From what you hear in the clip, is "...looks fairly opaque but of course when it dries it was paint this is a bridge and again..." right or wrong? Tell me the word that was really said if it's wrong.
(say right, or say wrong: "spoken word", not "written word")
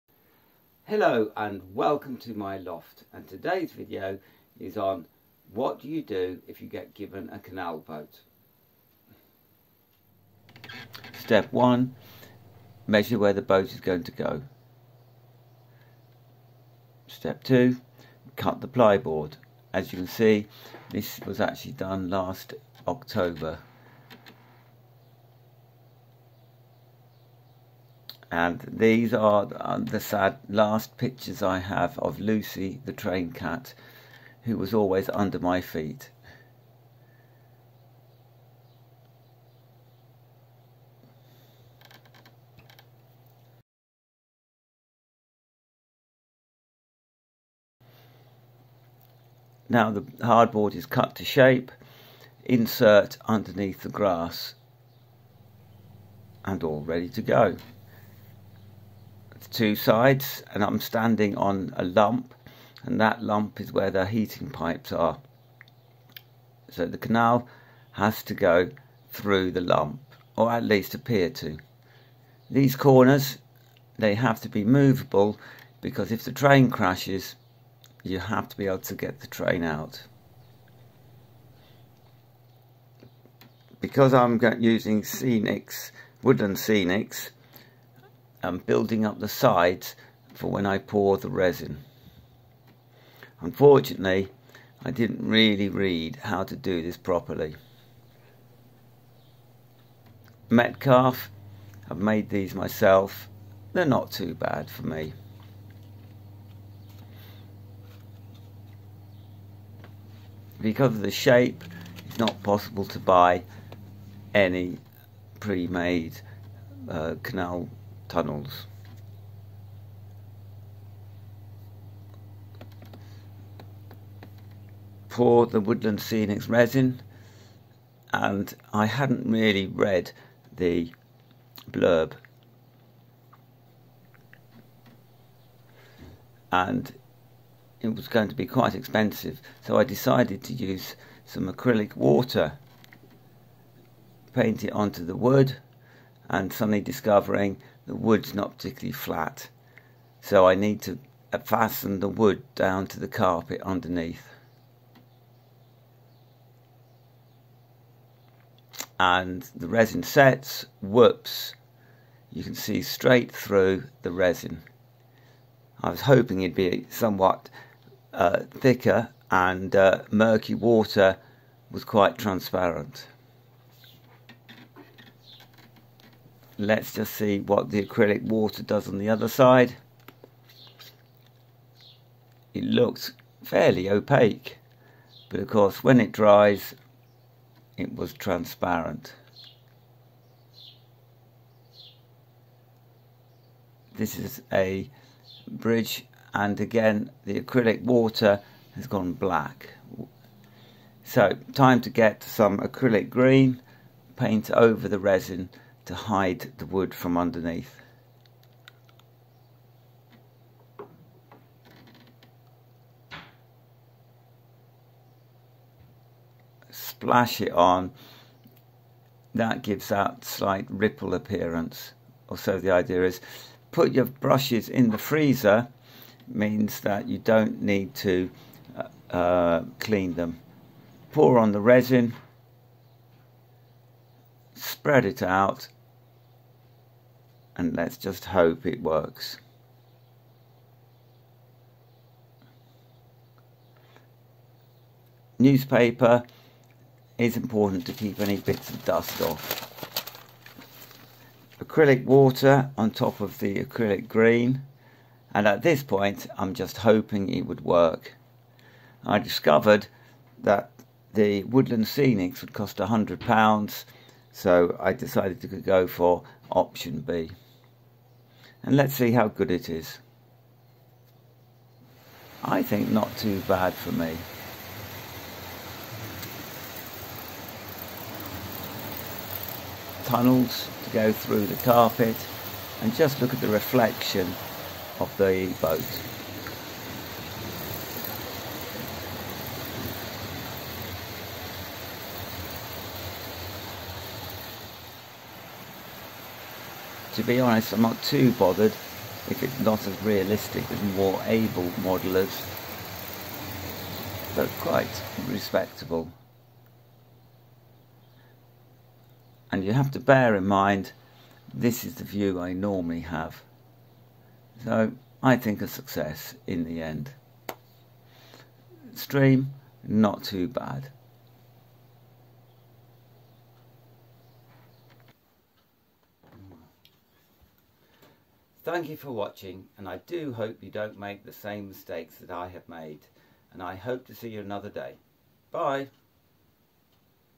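wrong: "transparent", not "paint".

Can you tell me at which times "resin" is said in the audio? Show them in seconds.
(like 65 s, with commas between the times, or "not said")
91 s, 126 s, 159 s, 164 s, 204 s, 231 s.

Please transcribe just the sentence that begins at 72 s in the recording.
These corners they have to be movable because if the train crashes you have to be able to get the train out.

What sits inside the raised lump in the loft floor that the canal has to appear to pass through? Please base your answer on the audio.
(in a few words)
heating pipes.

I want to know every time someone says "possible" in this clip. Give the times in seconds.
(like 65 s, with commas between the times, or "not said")
112 s.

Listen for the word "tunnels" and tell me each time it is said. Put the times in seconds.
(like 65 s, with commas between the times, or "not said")
118 s, 280 s.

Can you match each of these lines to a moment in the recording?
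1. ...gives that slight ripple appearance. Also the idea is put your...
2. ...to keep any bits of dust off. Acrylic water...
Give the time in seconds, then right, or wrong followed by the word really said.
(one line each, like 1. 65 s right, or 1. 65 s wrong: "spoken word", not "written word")
1. 219 s right
2. 247 s right.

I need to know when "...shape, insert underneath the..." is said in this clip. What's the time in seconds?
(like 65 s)
51 s.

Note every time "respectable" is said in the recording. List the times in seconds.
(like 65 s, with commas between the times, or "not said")
305 s.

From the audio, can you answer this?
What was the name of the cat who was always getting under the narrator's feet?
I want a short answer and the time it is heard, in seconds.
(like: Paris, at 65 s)
Lucy, at 32 s.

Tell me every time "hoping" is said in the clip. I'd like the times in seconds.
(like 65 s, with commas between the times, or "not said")
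166 s, 256 s.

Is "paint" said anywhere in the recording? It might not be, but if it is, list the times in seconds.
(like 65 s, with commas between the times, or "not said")
144 s, 204 s.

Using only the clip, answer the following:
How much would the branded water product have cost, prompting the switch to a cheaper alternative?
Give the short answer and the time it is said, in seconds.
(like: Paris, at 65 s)
£100, at 262 s.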